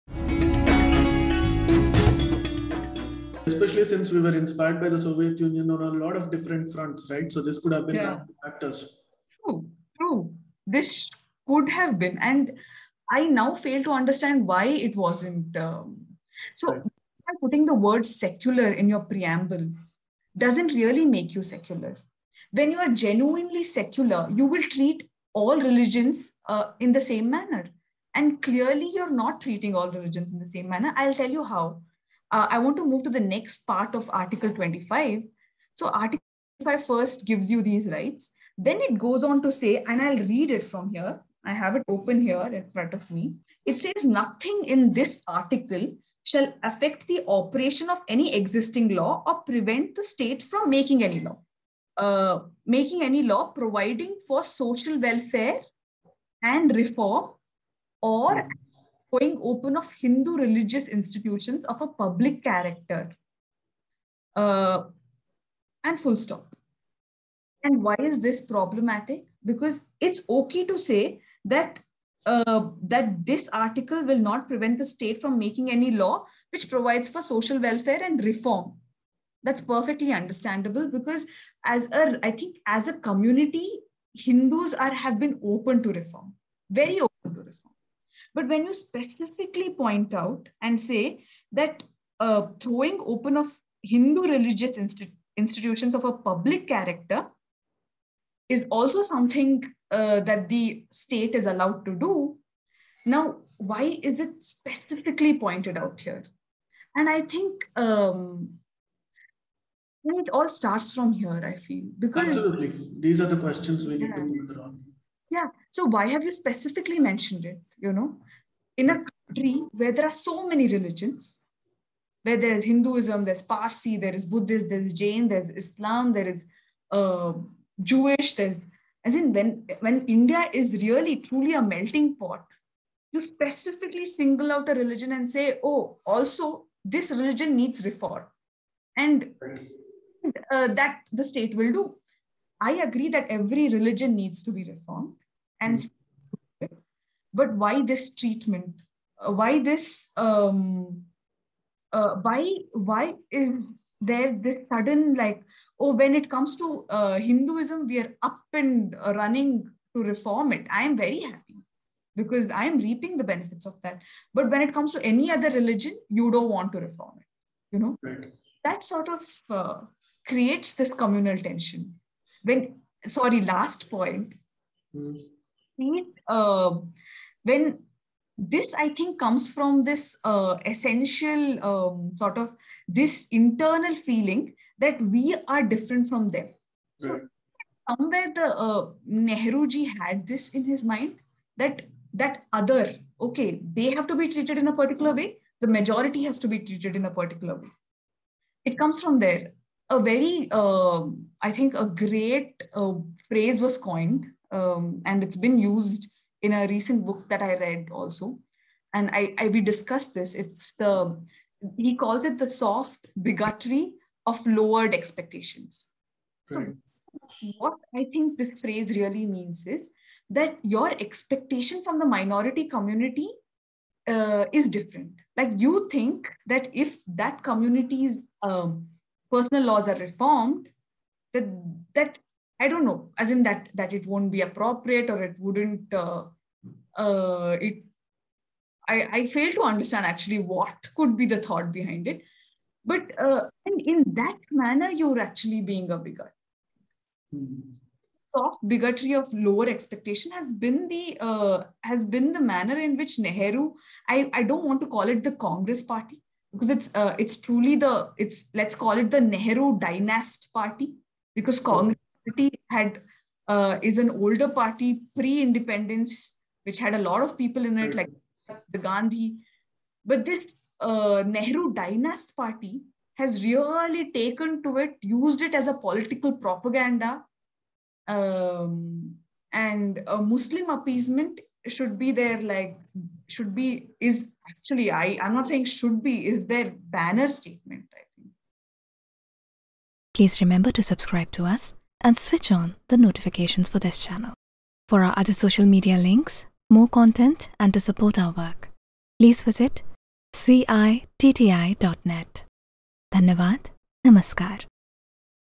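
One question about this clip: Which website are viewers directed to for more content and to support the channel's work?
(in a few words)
citti.net.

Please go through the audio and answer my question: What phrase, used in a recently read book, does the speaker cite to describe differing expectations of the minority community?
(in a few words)
soft bigotry of lowered expectations.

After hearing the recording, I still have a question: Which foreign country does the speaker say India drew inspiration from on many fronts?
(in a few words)
Soviet Union.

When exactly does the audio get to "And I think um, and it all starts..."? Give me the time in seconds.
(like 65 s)
106 s.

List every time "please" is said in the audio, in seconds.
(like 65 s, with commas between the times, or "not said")
290 s, 299 s.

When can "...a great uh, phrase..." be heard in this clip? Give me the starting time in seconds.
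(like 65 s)
201 s.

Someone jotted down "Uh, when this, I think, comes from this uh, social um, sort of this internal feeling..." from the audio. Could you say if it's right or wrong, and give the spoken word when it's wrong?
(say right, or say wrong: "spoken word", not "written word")
wrong: "essential", not "social".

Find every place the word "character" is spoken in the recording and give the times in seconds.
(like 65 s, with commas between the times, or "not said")
62 s, 96 s.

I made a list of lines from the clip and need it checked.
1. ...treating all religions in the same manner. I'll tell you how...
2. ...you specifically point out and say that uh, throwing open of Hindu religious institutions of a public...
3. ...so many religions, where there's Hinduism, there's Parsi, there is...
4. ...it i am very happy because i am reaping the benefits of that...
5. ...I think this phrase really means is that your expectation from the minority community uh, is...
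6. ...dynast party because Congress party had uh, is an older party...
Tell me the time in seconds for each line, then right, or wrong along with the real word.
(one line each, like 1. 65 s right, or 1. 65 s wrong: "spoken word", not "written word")
1. 29 s right
2. 88 s right
3. 120 s right
4. 160 s right
5. 217 s right
6. 259 s right.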